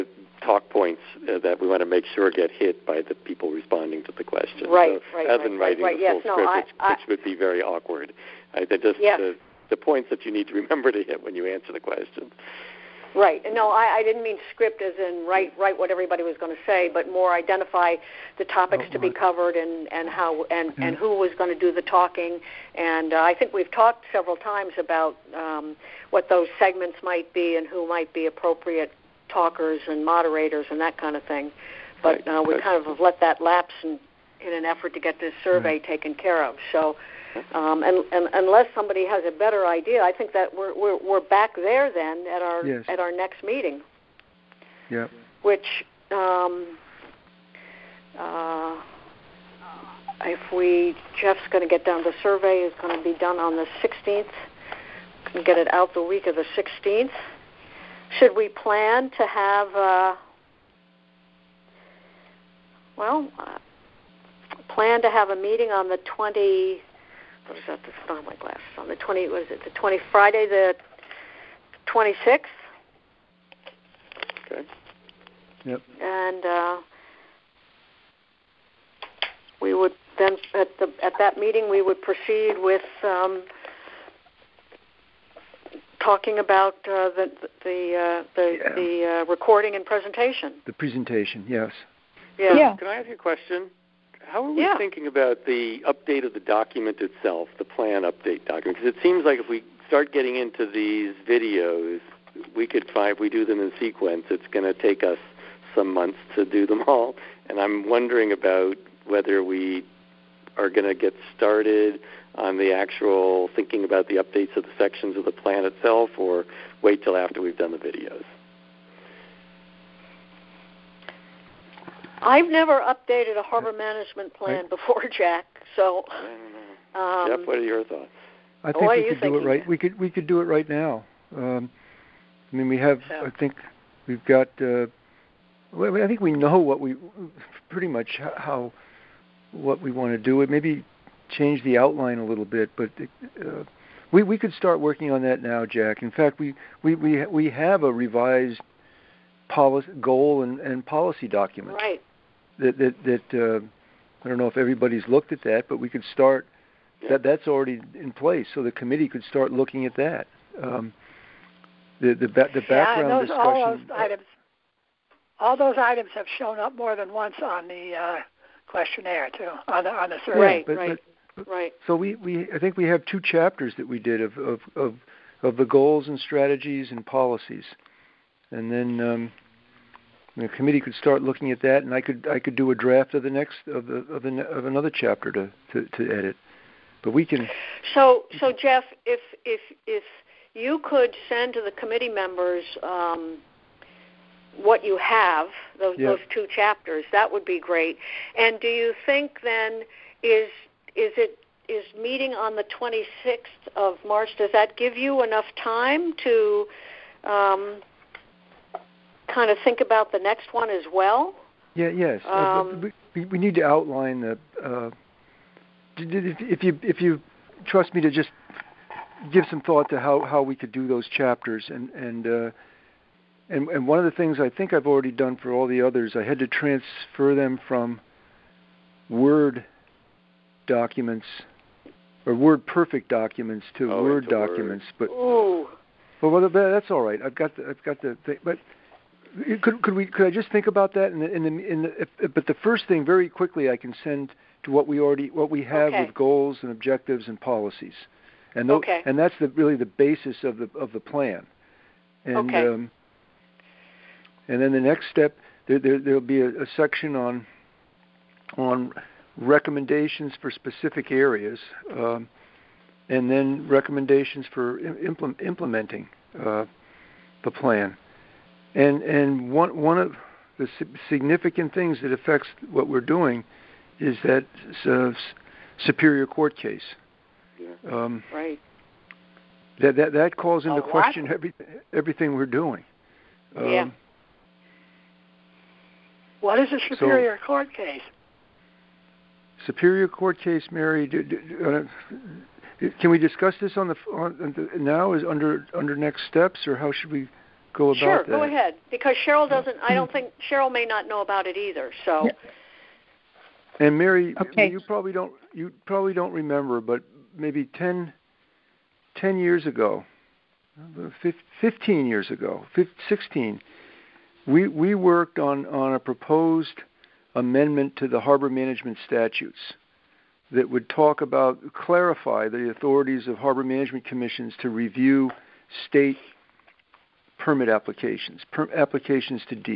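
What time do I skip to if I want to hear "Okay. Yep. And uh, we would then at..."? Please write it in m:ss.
1:14.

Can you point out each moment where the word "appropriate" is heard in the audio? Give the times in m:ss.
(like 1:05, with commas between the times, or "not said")
0:28.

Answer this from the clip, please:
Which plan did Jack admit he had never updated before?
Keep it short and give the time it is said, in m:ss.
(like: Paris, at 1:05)
harbor management plan, at 2:03.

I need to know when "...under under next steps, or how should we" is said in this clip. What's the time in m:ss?
4:55.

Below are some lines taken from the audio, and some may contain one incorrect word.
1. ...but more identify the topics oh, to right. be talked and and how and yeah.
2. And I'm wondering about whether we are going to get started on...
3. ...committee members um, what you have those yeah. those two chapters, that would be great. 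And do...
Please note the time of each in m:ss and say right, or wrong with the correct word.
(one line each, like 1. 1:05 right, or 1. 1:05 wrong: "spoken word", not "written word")
1. 0:16 wrong: "covered", not "talked"
2. 1:47 right
3. 3:11 right.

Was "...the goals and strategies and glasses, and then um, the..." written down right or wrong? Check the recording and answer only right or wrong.
wrong.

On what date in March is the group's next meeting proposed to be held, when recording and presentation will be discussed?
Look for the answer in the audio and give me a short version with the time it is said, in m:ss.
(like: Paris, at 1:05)
26th, at 1:10.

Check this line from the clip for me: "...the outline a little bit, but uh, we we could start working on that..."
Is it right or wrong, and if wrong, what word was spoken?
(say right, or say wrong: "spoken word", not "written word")
right.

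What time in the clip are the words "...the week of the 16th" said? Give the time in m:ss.
0:55.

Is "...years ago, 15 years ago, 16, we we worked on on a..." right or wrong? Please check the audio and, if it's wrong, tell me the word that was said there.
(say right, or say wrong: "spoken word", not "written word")
right.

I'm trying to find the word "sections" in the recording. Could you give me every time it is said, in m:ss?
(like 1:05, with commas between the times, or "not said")
1:54, 4:16.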